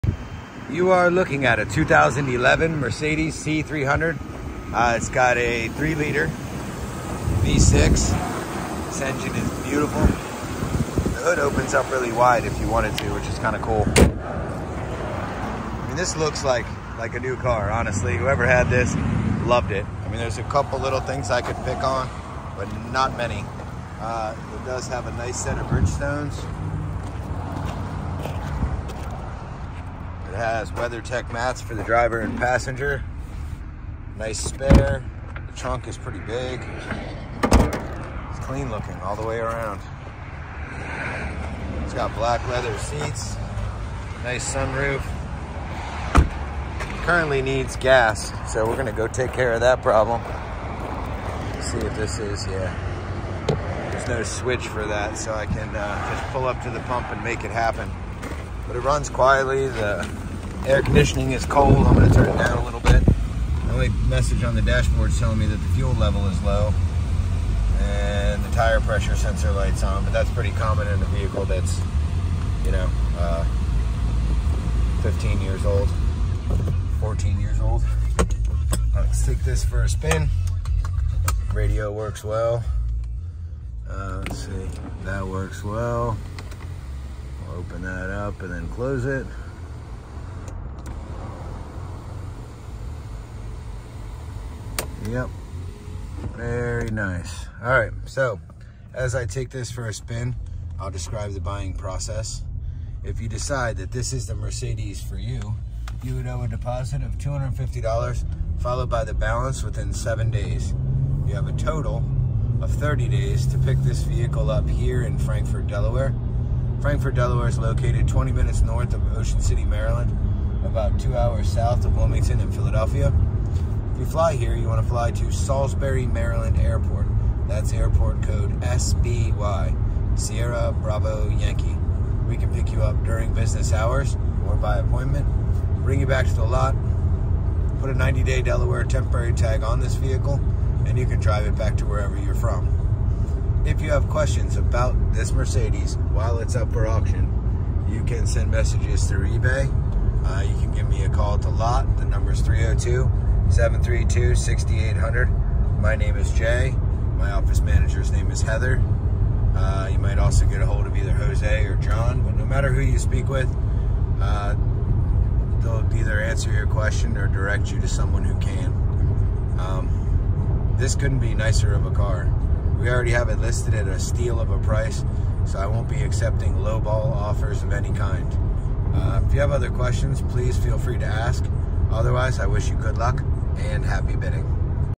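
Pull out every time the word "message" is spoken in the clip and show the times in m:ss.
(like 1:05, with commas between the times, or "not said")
1:04, 2:28.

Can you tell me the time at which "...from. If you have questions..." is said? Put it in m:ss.
2:22.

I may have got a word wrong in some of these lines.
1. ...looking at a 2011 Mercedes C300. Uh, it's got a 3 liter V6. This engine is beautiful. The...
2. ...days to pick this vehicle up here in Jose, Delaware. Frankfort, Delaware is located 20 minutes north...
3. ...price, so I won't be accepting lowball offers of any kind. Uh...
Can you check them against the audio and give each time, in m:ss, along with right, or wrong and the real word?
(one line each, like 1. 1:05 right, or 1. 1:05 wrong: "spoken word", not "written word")
1. 0:01 right
2. 1:53 wrong: "Frankfort", not "Jose"
3. 2:54 right.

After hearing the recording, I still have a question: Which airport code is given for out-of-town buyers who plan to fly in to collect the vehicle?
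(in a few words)
SBY.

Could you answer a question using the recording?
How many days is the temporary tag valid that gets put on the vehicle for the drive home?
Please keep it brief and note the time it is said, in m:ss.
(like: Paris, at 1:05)
90, at 2:17.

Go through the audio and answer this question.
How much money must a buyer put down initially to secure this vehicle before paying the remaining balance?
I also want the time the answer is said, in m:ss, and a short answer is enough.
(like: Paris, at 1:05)
$250, at 1:47.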